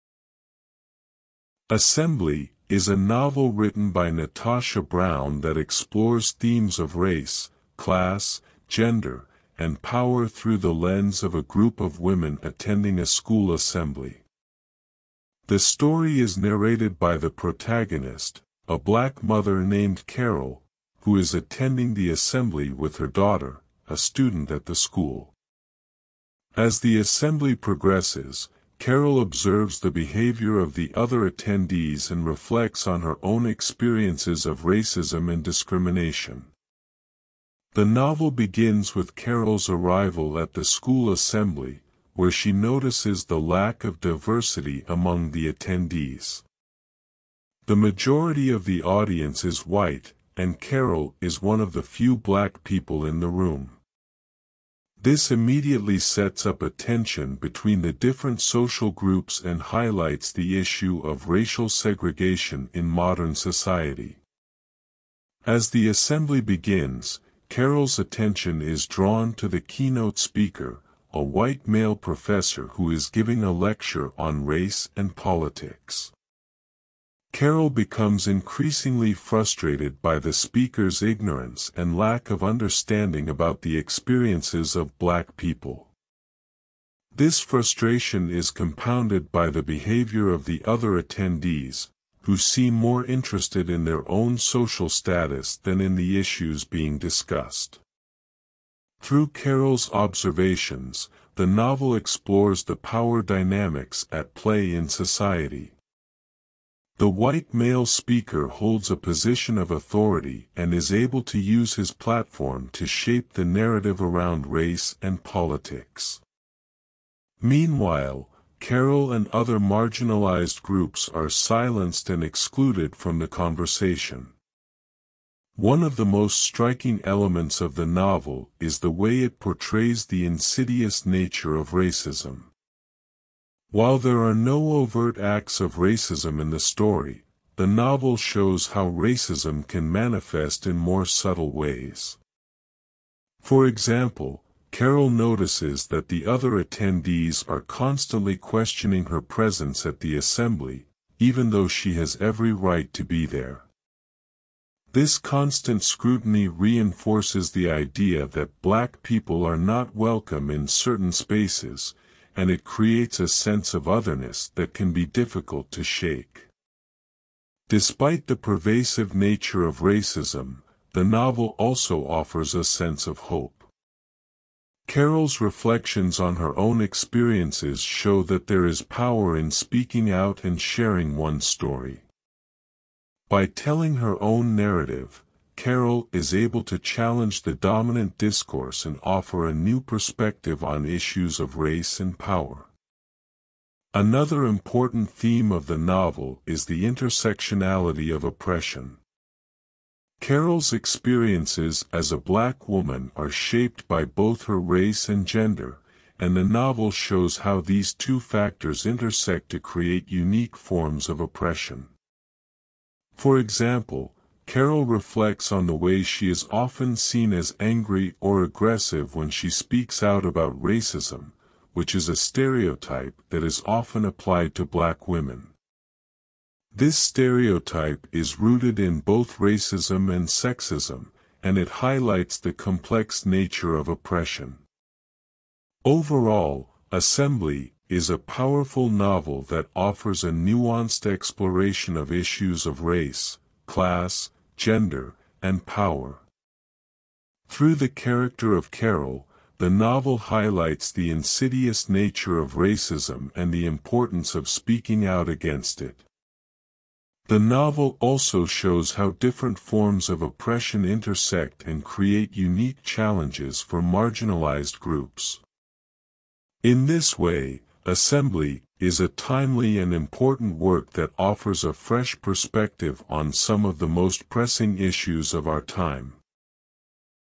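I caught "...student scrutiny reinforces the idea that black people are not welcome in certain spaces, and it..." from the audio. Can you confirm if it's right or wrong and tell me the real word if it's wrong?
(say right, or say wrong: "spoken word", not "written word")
wrong: "constant", not "student".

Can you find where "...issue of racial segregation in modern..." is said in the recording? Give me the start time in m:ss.
1:00.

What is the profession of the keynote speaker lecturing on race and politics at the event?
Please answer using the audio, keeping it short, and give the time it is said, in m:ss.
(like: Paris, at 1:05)
Professor, at 1:11.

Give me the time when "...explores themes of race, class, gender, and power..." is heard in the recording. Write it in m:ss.
0:05.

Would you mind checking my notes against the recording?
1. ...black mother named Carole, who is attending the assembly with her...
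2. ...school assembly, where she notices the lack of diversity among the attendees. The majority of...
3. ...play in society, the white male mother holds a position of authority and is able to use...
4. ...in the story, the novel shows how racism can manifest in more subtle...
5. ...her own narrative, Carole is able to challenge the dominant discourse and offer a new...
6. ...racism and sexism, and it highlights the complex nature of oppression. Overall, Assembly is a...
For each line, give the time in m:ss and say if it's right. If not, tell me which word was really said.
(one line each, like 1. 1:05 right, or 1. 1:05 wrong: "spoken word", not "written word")
1. 0:18 right
2. 0:40 right
3. 1:44 wrong: "speaker", not "mother"
4. 2:16 right
5. 3:03 right
6. 3:49 right.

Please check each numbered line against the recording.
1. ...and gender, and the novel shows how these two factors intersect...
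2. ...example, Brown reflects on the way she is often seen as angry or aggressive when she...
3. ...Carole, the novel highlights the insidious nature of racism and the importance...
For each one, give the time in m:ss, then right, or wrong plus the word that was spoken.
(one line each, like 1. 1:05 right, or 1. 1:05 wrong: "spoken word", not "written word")
1. 3:25 right
2. 3:33 wrong: "Carole", not "Brown"
3. 4:08 right.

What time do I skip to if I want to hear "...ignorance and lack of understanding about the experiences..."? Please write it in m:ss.
1:21.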